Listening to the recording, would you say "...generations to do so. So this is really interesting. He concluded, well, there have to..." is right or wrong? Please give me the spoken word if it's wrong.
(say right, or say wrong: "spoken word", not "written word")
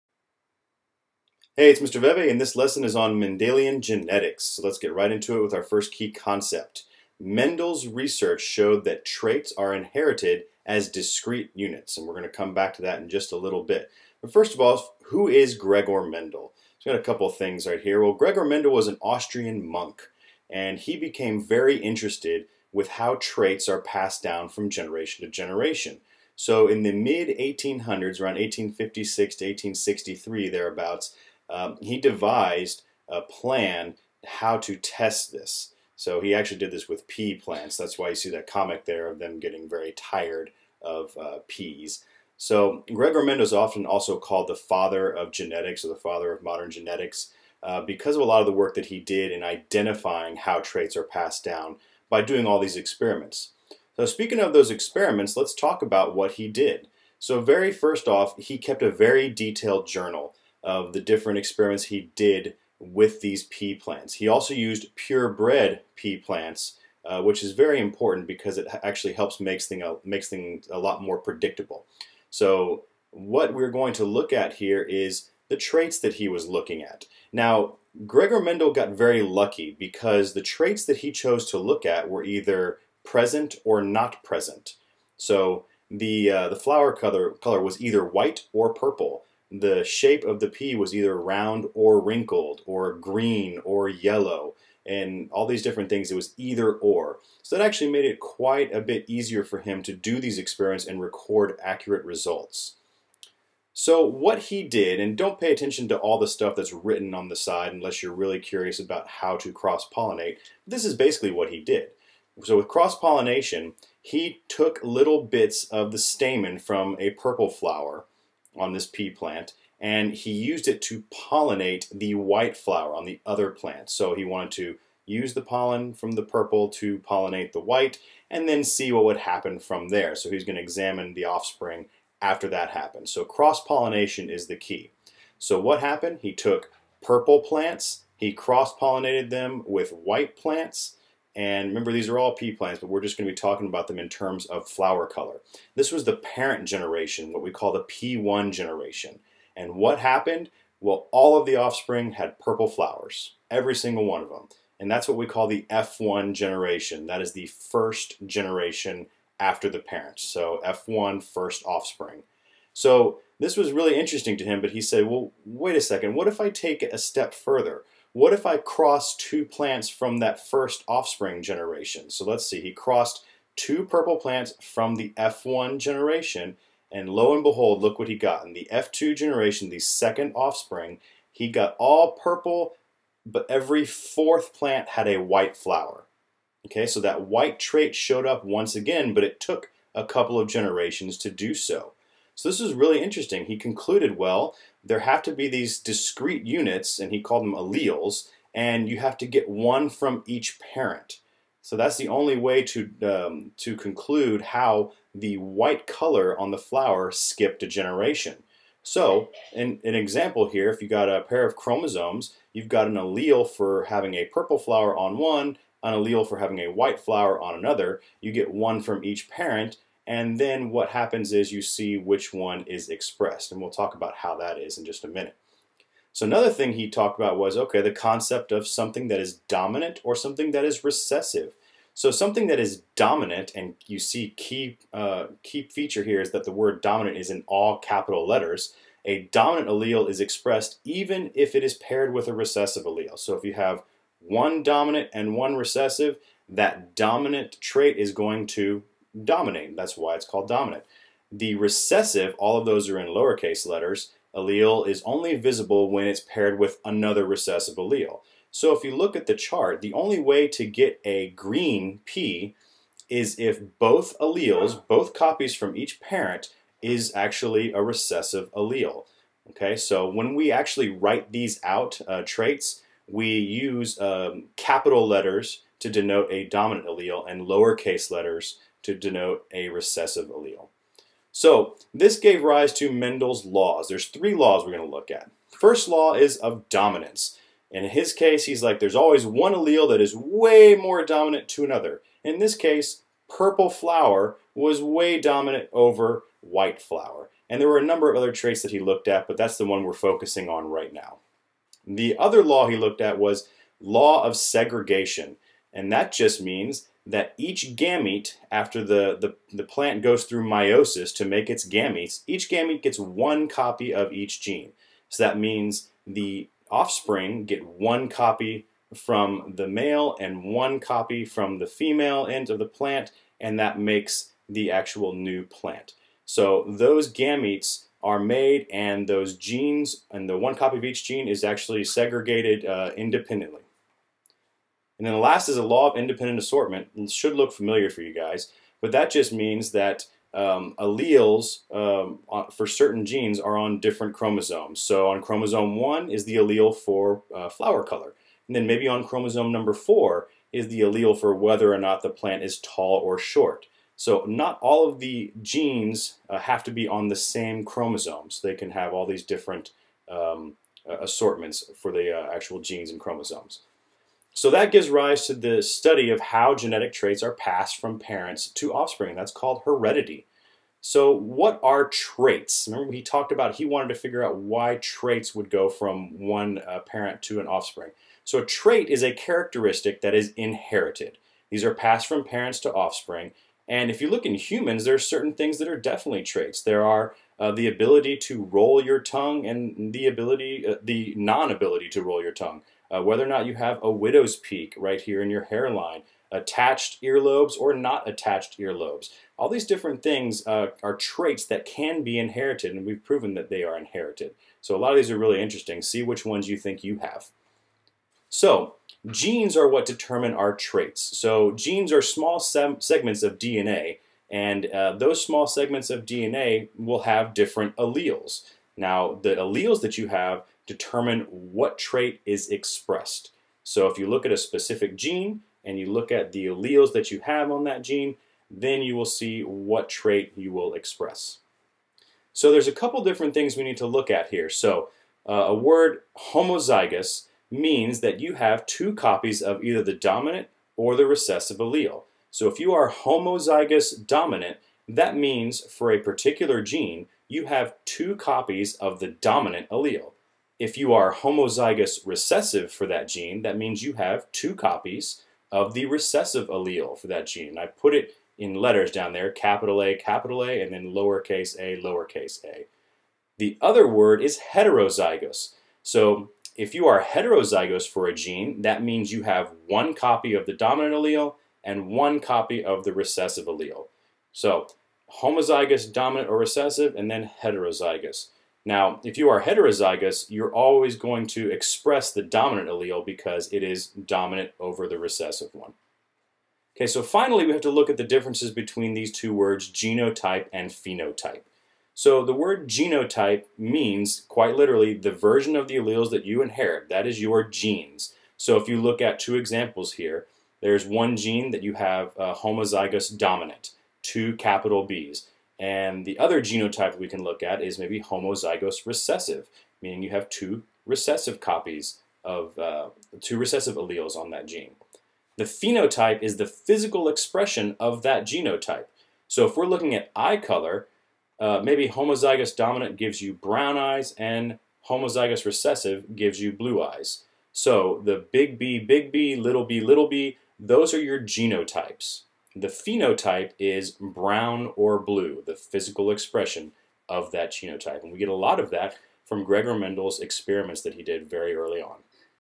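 right.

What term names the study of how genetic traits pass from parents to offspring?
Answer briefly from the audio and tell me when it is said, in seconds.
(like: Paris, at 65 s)
Heredity, at 369 s.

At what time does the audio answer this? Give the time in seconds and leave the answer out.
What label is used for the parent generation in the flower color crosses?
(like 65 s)
147 s.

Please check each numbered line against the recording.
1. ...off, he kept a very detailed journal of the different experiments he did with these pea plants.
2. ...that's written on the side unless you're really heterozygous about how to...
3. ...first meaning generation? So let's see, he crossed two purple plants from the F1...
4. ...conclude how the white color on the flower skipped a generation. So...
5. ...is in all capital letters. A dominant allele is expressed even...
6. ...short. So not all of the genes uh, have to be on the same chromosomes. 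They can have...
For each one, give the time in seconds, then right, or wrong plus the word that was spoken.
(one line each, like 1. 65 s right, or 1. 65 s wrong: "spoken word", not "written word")
1. 58 s right
2. 106 s wrong: "curious", not "heterozygous"
3. 170 s wrong: "offspring", not "meaning"
4. 203 s right
5. 237 s right
6. 353 s right.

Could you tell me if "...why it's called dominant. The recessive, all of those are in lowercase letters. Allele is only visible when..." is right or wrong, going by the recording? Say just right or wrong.
right.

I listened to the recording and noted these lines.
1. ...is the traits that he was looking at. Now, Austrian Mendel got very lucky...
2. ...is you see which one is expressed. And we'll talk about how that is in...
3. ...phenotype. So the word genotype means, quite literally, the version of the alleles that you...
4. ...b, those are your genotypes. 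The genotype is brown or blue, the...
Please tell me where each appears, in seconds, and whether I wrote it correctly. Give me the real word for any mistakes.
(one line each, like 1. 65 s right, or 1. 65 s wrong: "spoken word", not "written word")
1. 74 s wrong: "Gregor", not "Austrian"
2. 221 s right
3. 490 s right
4. 530 s wrong: "phenotype", not "genotype".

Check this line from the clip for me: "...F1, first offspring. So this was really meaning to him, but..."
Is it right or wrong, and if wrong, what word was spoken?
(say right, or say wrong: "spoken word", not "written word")
wrong: "interesting", not "meaning".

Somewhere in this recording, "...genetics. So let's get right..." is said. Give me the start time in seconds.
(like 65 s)
3 s.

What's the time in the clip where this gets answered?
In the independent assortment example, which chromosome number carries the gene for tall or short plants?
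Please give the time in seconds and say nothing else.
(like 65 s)
349 s.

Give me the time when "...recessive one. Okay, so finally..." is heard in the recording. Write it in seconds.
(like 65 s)
484 s.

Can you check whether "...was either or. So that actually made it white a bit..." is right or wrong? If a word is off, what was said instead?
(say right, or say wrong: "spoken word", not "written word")
wrong: "quite", not "white".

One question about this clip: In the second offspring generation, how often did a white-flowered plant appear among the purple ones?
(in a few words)
Every fourth plant.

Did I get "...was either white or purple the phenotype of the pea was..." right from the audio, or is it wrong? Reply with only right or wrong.
wrong.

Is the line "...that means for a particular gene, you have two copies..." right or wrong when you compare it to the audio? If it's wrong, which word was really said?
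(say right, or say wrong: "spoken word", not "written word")
right.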